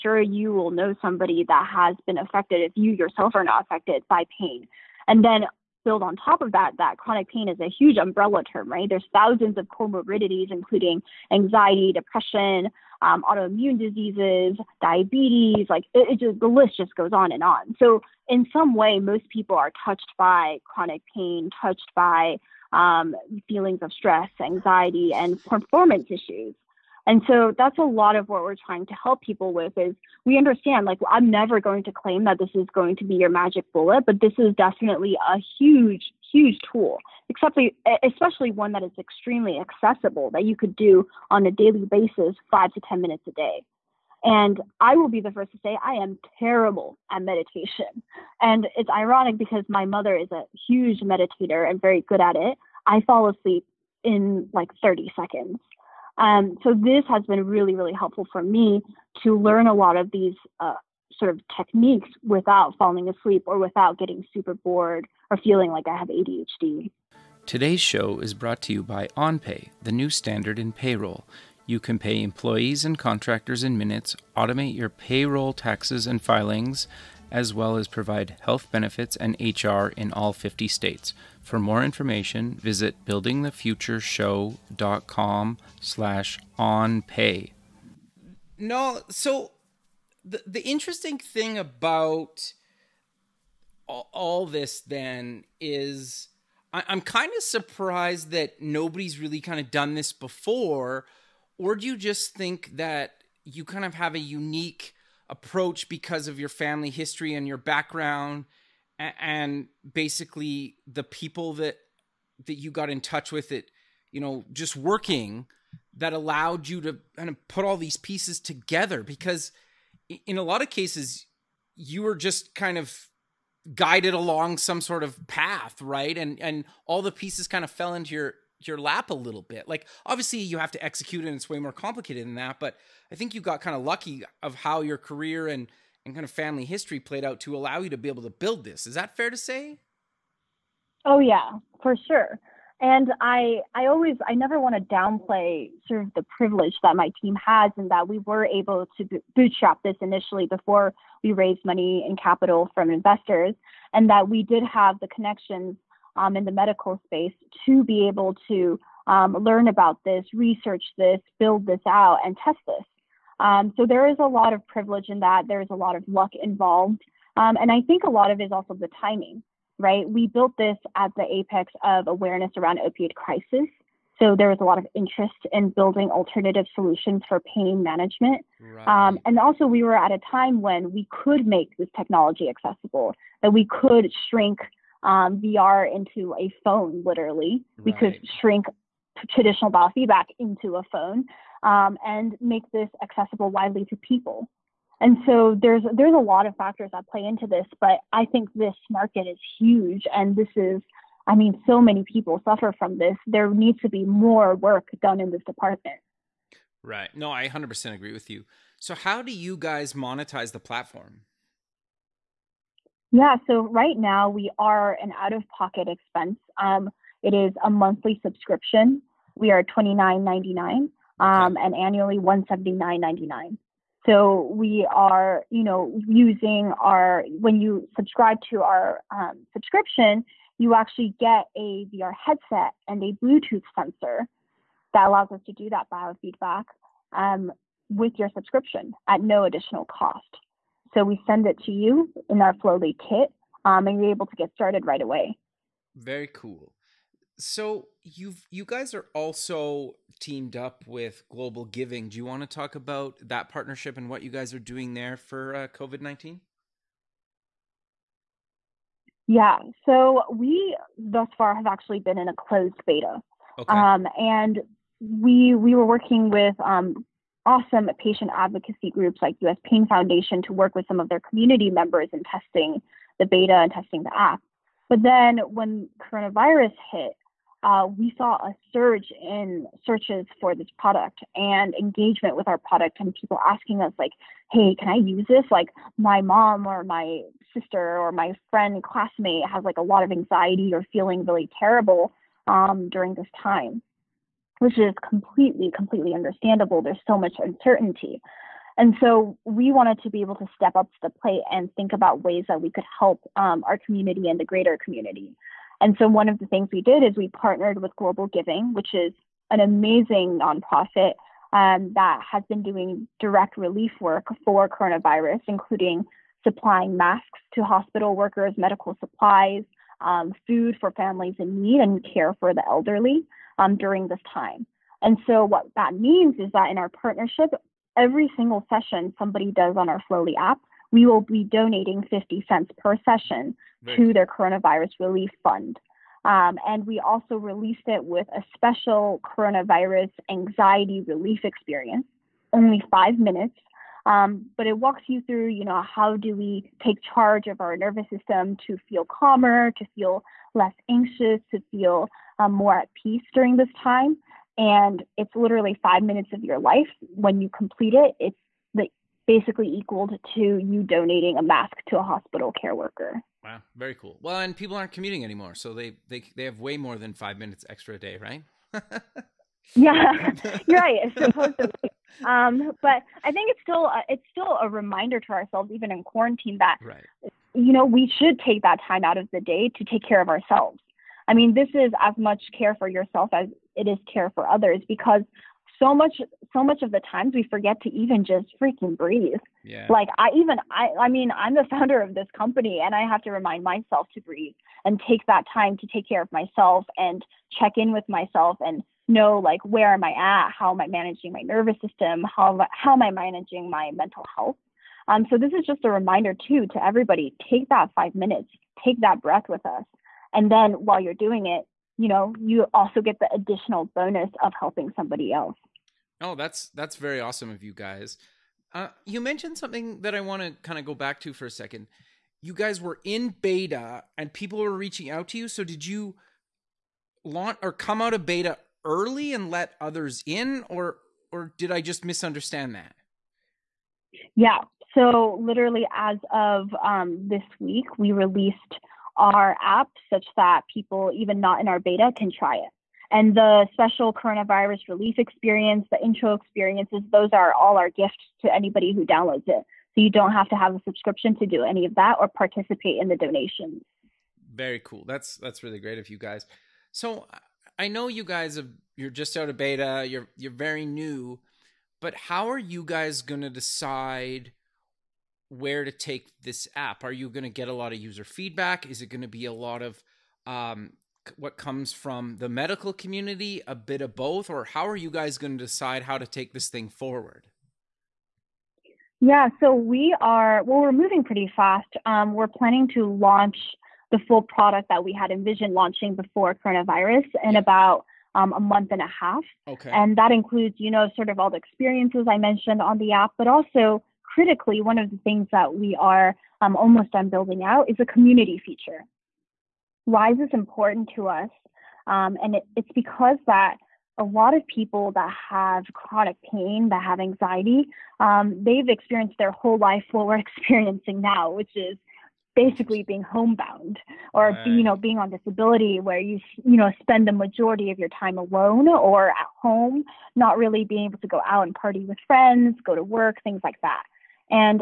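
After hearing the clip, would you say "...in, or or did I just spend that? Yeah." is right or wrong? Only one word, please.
wrong.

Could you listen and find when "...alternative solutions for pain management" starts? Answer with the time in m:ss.
2:56.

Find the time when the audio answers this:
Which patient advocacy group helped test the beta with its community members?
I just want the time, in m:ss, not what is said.
4:29.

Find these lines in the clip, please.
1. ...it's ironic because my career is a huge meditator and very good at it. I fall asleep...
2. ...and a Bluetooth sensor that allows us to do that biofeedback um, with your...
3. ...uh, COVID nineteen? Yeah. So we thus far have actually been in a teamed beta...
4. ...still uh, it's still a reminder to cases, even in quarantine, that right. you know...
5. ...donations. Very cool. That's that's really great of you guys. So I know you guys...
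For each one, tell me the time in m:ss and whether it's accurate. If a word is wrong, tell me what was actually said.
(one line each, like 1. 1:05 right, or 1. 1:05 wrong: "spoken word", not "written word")
1. 0:48 wrong: "mother", not "career"
2. 3:52 right
3. 4:15 wrong: "closed", not "teamed"
4. 6:13 wrong: "ourselves", not "cases"
5. 7:33 right.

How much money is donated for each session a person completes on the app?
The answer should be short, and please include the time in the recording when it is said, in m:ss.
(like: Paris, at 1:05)
50 cents, at 5:32.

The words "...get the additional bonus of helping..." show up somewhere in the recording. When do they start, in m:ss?
6:53.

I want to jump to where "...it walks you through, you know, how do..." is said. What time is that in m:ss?
5:44.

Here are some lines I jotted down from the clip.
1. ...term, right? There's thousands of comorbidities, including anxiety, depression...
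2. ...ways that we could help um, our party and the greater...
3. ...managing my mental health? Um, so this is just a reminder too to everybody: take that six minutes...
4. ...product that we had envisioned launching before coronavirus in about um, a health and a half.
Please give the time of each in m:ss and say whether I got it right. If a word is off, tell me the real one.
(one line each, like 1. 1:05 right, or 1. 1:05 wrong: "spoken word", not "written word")
1. 0:08 right
2. 5:02 wrong: "community", not "party"
3. 6:43 wrong: "five", not "six"
4. 8:04 wrong: "month", not "health".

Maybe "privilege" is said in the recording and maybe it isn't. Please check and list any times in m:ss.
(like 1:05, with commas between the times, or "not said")
2:26, 2:44.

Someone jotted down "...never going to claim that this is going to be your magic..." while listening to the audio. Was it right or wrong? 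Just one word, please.
right.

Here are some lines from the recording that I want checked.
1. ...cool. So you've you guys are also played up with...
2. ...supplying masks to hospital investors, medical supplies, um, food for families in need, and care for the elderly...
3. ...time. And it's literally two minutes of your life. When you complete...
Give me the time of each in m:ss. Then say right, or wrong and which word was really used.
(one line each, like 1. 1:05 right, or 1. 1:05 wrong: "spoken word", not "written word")
1. 4:06 wrong: "teamed", not "played"
2. 5:16 wrong: "workers", not "investors"
3. 5:53 wrong: "five", not "two".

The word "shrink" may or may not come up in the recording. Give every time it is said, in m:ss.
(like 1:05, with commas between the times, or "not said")
3:04, 3:08.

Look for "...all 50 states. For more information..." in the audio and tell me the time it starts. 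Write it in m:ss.
1:20.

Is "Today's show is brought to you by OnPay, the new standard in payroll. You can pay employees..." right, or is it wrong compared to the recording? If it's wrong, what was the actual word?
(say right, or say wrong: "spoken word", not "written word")
right.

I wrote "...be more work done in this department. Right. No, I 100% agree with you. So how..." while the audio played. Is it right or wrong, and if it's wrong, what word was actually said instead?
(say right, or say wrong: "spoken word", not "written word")
right.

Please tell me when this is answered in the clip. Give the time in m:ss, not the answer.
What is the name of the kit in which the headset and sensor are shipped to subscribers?
4:02.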